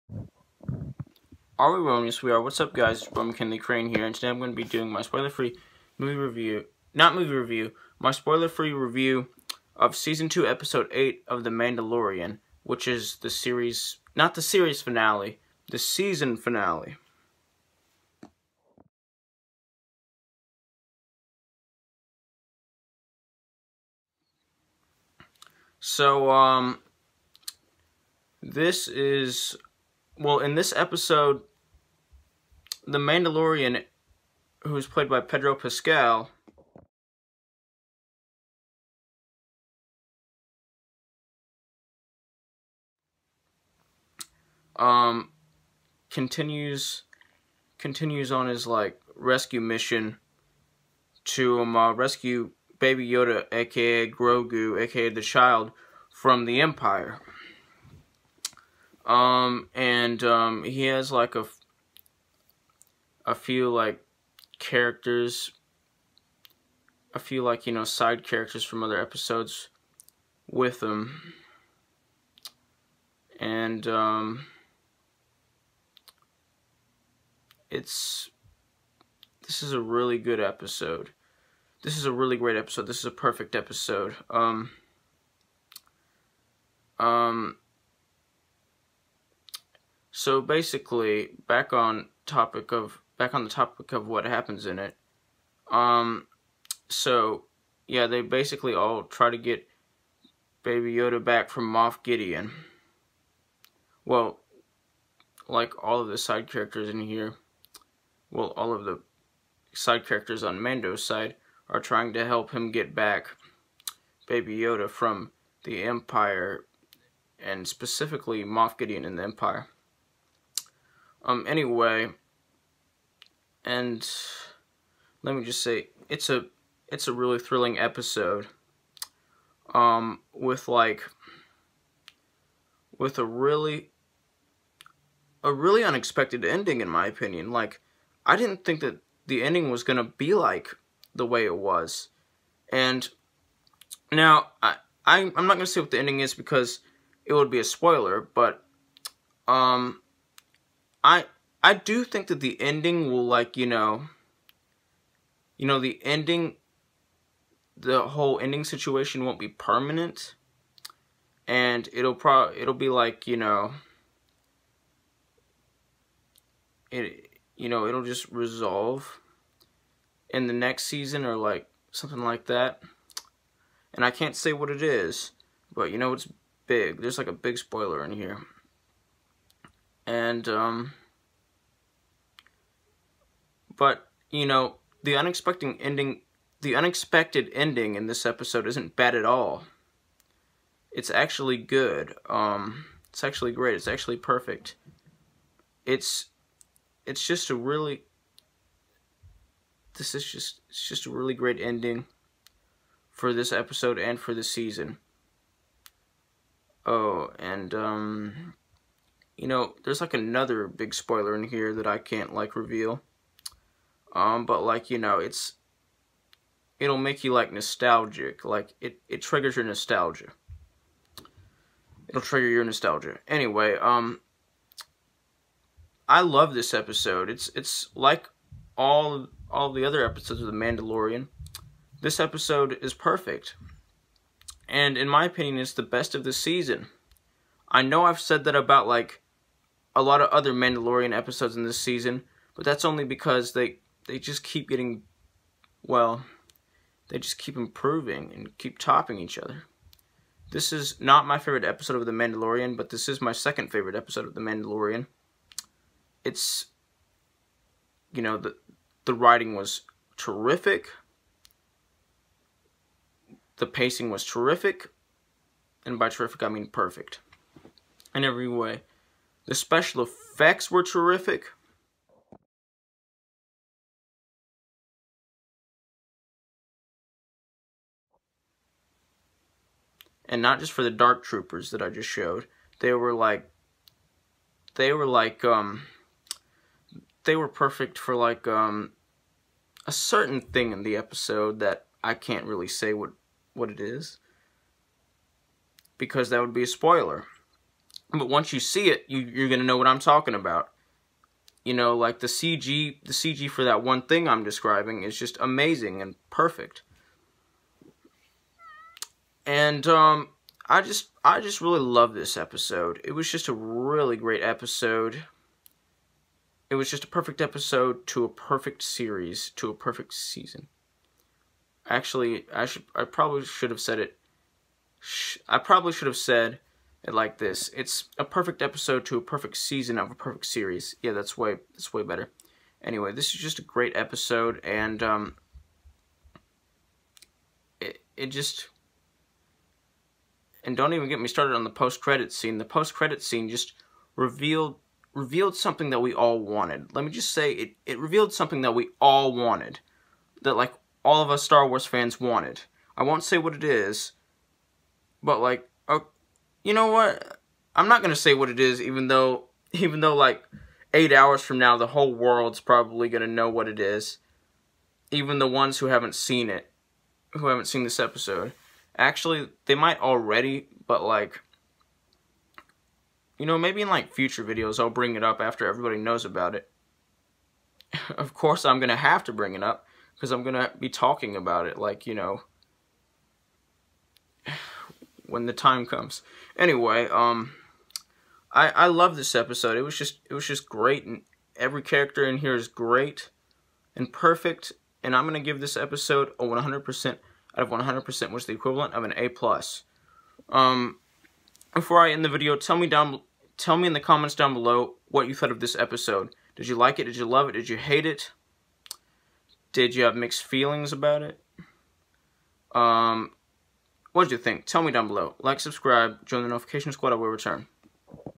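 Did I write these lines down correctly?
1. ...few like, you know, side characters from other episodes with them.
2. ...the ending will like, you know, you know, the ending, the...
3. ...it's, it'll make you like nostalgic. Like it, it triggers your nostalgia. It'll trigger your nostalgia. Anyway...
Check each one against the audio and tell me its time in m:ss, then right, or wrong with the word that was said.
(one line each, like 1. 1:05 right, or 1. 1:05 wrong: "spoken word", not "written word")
1. 1:07 right
2. 2:32 right
3. 3:35 right.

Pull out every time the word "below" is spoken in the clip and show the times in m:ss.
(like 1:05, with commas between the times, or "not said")
6:44, 6:55.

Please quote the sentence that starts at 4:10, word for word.
This is not my favorite episode of The Mandalorian, but this is my second favorite episode of The Mandalorian.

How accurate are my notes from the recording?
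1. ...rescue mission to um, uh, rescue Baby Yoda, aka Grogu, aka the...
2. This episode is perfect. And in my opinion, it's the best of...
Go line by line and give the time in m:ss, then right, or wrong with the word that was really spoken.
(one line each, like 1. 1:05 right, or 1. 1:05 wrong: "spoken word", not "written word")
1. 0:49 right
2. 3:52 right.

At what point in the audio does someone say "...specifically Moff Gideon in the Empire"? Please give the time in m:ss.
1:57.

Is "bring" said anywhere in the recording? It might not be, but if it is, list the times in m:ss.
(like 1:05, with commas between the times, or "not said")
6:14, 6:19.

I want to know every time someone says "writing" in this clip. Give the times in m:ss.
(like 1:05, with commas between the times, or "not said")
4:19.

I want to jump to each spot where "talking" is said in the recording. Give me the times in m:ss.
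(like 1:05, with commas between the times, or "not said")
4:59, 6:20.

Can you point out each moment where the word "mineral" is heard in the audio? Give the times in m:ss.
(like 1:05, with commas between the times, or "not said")
not said.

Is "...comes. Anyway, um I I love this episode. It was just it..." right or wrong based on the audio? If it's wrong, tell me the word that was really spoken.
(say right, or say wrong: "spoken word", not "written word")
right.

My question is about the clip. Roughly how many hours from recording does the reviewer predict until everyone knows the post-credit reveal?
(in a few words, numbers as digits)
8.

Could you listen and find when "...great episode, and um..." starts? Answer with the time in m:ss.
5:33.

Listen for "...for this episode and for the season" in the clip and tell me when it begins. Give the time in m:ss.
3:23.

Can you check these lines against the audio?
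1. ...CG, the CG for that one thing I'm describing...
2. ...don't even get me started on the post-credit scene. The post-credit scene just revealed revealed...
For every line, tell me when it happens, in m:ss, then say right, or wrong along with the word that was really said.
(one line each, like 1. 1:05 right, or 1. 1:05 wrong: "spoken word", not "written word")
1. 5:02 right
2. 5:40 right.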